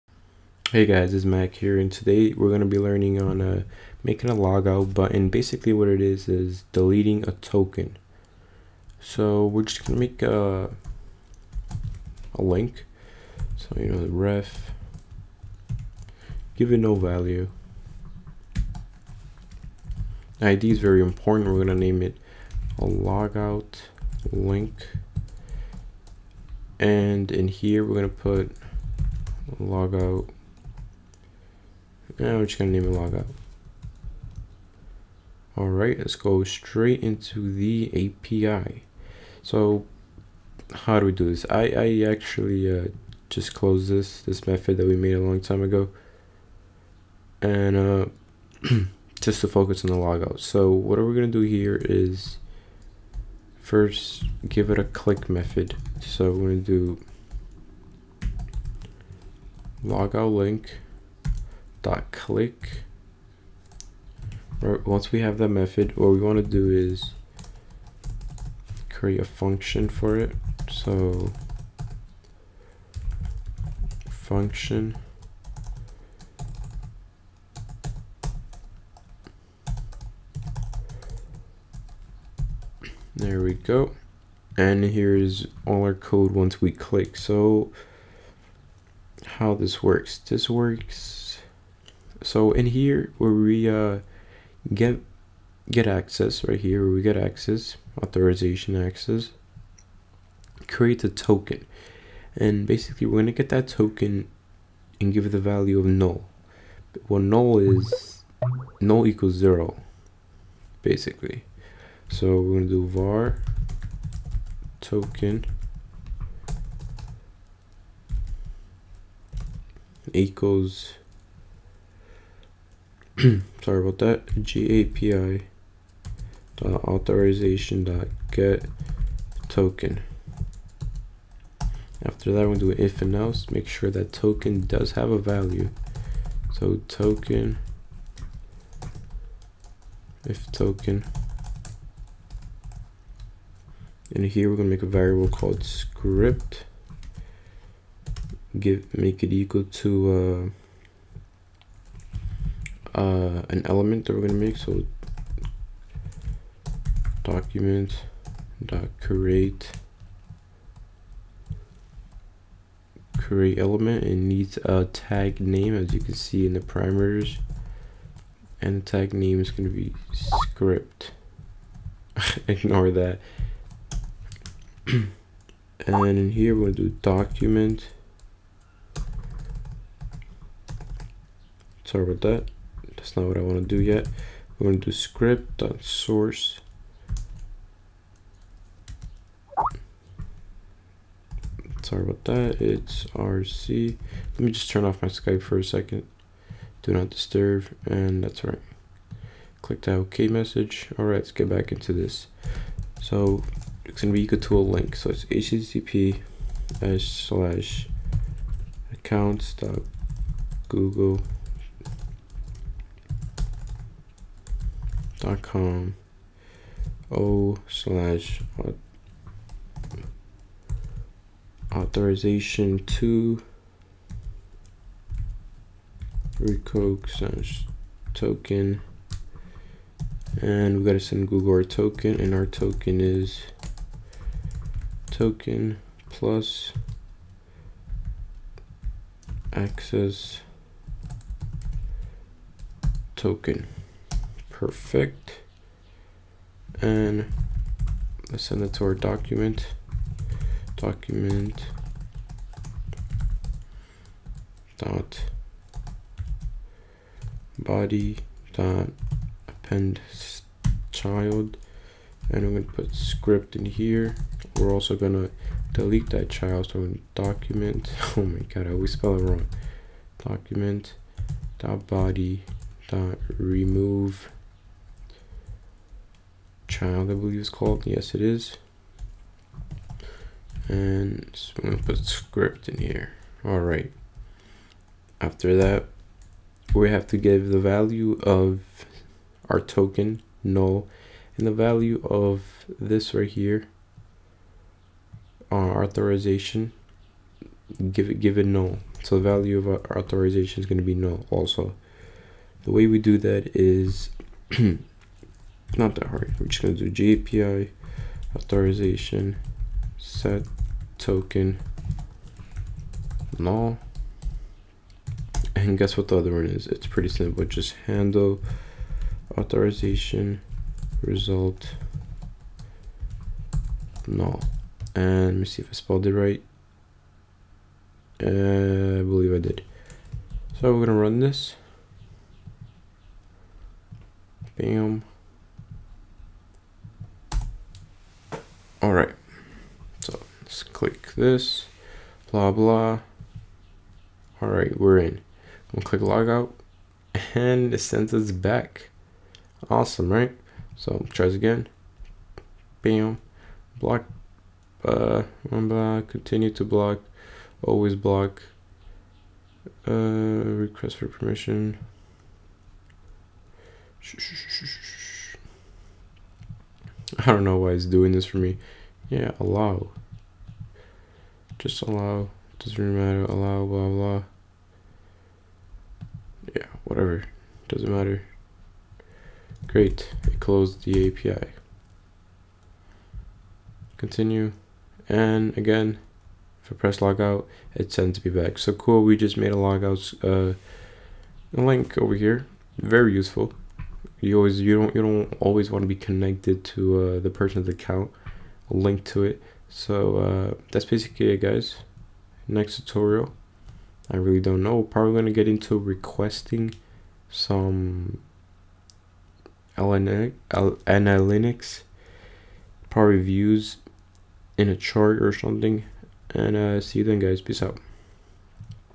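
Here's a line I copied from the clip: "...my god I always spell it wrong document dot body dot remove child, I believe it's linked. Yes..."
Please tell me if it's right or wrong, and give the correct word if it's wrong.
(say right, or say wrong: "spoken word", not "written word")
wrong: "called", not "linked".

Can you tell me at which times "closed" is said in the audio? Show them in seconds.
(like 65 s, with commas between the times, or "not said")
43 s, 380 s.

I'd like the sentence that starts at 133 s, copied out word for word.
Make sure that token does have a value.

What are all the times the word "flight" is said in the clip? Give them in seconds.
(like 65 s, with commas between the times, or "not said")
not said.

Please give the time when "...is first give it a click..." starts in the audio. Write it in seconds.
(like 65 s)
51 s.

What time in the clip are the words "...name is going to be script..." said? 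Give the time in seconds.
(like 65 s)
169 s.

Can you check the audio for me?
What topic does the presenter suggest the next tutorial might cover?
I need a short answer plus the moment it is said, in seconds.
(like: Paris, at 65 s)
analytics, at 410 s.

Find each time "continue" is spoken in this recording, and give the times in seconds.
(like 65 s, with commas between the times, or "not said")
356 s, 383 s.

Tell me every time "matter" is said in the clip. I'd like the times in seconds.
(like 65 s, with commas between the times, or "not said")
372 s, 377 s.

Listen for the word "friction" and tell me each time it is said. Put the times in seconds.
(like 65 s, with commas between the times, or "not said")
not said.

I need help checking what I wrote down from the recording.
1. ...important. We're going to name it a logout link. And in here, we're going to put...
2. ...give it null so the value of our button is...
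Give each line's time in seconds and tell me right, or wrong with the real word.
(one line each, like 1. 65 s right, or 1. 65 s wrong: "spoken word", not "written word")
1. 21 s right
2. 298 s wrong: "authorization", not "button".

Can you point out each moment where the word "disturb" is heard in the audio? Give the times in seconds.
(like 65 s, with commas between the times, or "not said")
197 s.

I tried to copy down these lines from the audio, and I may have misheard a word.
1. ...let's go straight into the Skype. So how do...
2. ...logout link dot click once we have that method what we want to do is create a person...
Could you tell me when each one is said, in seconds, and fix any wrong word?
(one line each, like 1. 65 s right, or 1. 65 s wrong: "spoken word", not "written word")
1. 35 s wrong: "API", not "Skype"
2. 59 s wrong: "function", not "person".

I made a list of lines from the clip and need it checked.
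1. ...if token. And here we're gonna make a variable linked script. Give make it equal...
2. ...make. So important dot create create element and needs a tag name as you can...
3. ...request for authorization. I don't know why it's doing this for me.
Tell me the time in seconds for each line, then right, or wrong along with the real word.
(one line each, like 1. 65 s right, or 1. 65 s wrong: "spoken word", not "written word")
1. 140 s wrong: "called", not "linked"
2. 154 s wrong: "document", not "important"
3. 360 s wrong: "permission", not "authorization".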